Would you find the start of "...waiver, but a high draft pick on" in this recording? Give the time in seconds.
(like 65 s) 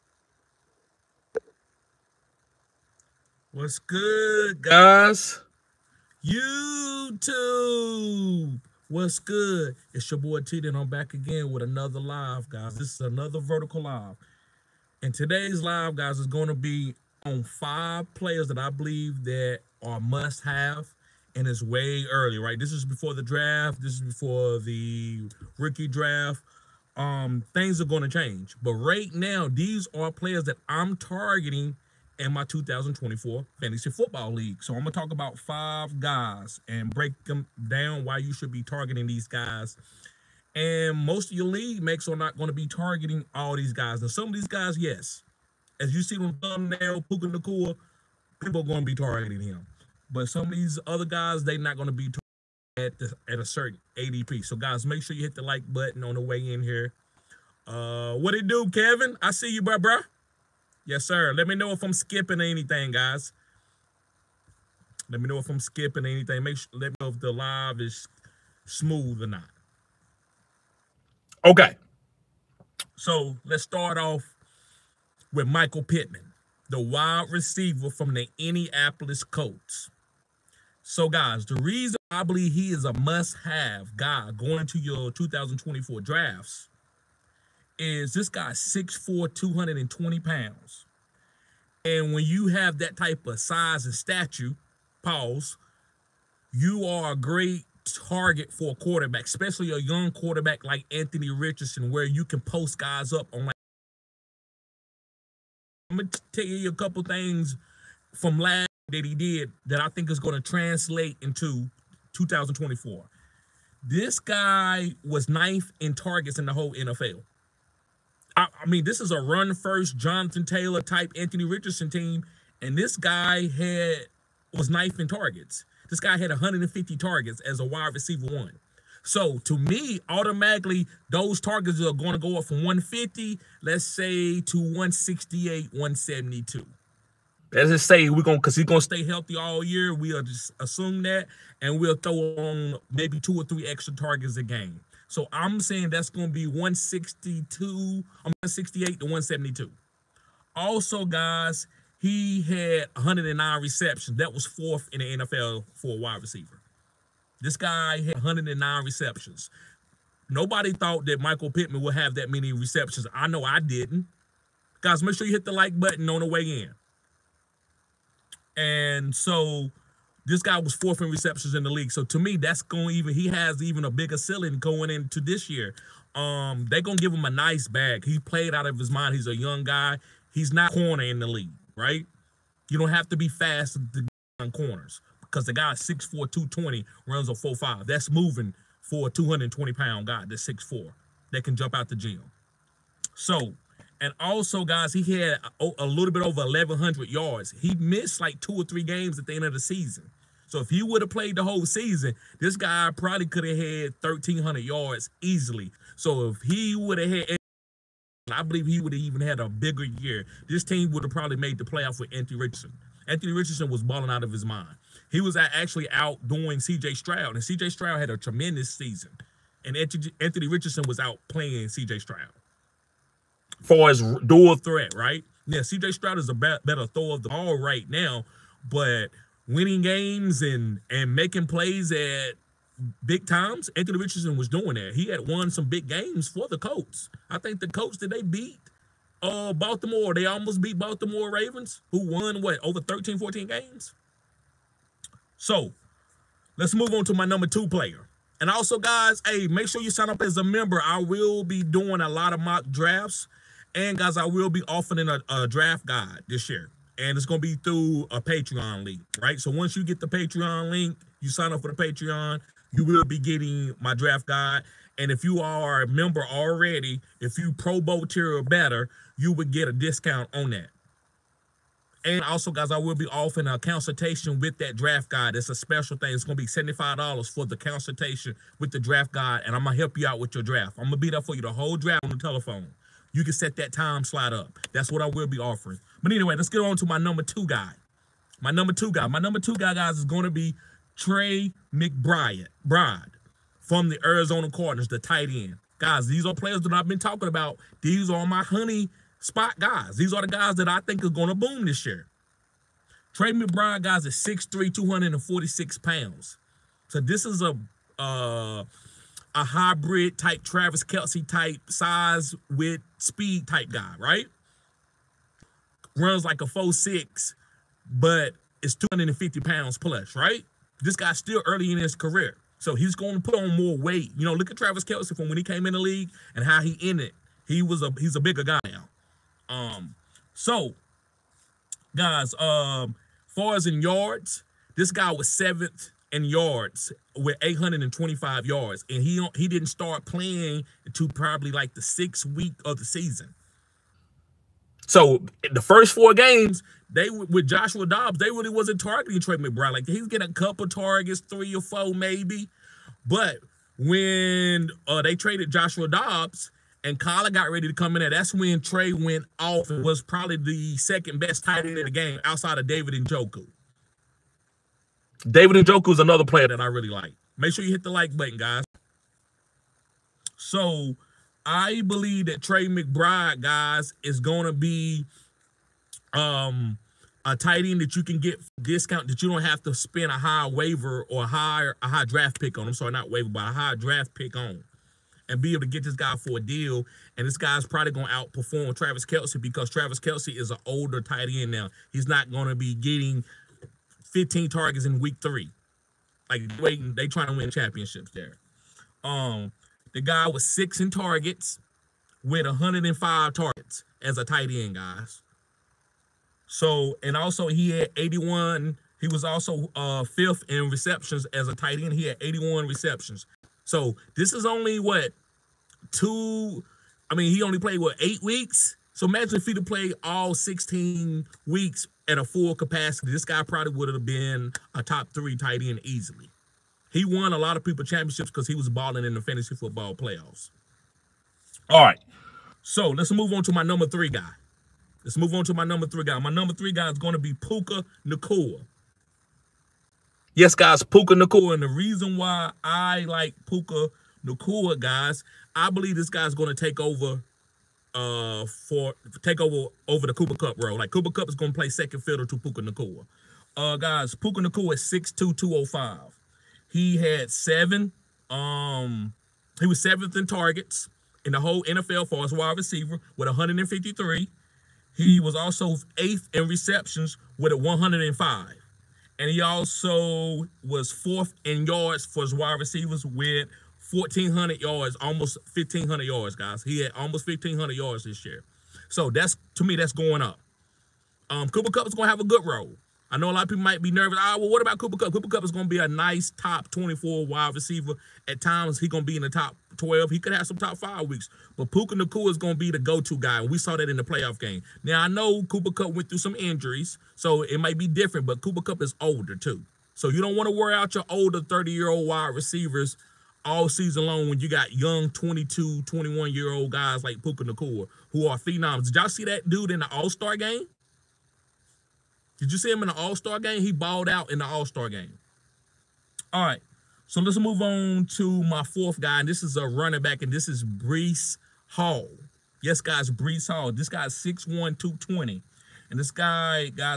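383 s.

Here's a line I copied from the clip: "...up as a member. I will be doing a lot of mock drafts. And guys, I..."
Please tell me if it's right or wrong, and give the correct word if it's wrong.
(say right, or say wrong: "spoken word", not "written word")
right.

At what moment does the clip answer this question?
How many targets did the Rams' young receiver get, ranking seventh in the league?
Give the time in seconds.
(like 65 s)
463 s.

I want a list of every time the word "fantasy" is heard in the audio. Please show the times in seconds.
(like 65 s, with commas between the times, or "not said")
33 s, 429 s.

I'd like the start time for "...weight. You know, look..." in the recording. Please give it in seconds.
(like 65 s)
323 s.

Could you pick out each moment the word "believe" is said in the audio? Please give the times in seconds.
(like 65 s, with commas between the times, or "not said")
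18 s, 82 s, 208 s, 371 s, 445 s.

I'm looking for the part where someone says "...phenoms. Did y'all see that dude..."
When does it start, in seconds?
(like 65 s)
508 s.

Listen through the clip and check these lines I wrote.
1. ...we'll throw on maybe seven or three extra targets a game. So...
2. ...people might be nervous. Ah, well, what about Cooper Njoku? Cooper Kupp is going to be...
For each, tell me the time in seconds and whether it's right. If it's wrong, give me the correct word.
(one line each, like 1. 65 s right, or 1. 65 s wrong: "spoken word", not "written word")
1. 141 s wrong: "two", not "seven"
2. 483 s wrong: "Kupp", not "Njoku".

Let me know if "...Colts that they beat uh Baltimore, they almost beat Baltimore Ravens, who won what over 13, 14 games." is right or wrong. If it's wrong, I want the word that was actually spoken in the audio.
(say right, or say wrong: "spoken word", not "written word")
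right.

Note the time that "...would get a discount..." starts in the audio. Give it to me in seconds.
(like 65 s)
269 s.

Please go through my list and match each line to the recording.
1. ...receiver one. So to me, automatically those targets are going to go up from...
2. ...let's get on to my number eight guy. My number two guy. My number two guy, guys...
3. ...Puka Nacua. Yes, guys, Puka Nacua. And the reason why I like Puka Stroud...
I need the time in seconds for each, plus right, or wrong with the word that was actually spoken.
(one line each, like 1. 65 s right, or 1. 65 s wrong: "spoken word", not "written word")
1. 127 s right
2. 286 s wrong: "two", not "eight"
3. 437 s wrong: "Nacua", not "Stroud".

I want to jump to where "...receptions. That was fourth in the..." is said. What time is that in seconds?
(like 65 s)
153 s.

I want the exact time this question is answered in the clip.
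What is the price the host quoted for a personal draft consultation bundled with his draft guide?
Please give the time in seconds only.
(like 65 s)
276 s.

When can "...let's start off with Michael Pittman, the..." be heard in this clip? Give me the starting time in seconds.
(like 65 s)
73 s.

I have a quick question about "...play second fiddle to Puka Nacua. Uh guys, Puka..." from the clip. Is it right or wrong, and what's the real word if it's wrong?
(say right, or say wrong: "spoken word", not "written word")
right.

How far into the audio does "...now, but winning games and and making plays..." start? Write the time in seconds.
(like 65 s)
227 s.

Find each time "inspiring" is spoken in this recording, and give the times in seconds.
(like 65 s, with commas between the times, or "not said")
not said.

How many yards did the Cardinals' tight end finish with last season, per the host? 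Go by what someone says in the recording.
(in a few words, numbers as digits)
825.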